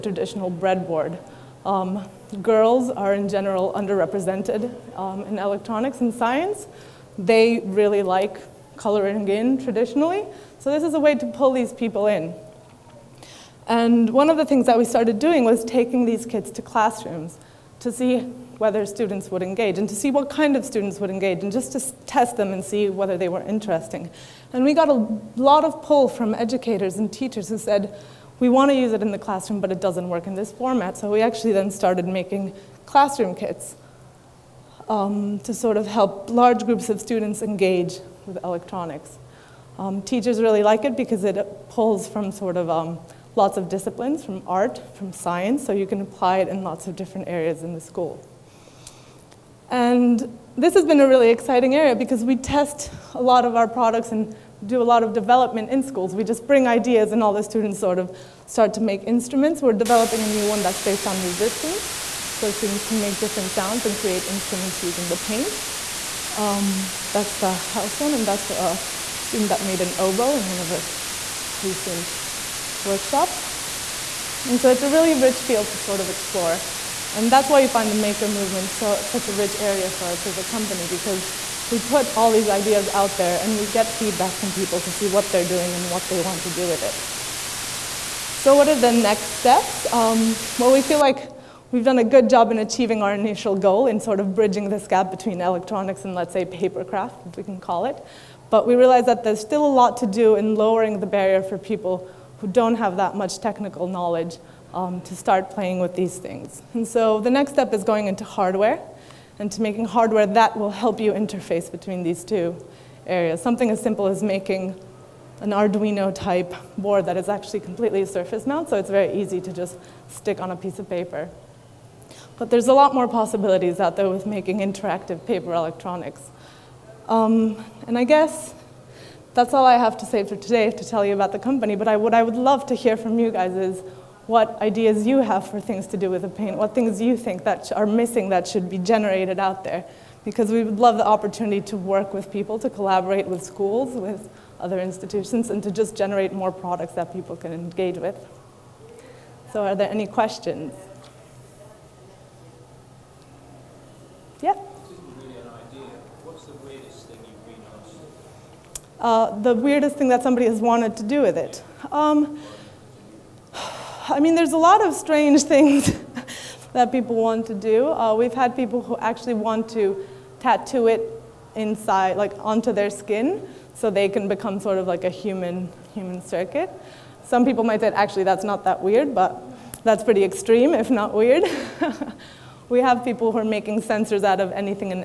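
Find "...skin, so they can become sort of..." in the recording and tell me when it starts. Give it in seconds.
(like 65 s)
172 s.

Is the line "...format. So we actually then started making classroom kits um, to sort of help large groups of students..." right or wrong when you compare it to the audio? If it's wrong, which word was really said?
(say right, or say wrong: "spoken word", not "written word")
right.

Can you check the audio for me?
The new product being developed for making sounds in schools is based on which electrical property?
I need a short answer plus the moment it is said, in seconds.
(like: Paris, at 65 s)
resistance, at 61 s.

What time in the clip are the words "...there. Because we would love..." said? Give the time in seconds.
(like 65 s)
139 s.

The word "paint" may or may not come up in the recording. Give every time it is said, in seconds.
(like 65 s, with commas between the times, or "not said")
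65 s, 136 s.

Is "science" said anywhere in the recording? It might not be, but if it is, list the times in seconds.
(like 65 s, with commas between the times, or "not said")
6 s, 45 s.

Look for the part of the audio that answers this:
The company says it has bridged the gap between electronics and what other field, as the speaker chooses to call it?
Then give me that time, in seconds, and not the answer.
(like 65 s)
96 s.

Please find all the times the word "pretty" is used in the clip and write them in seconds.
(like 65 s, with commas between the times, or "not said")
180 s.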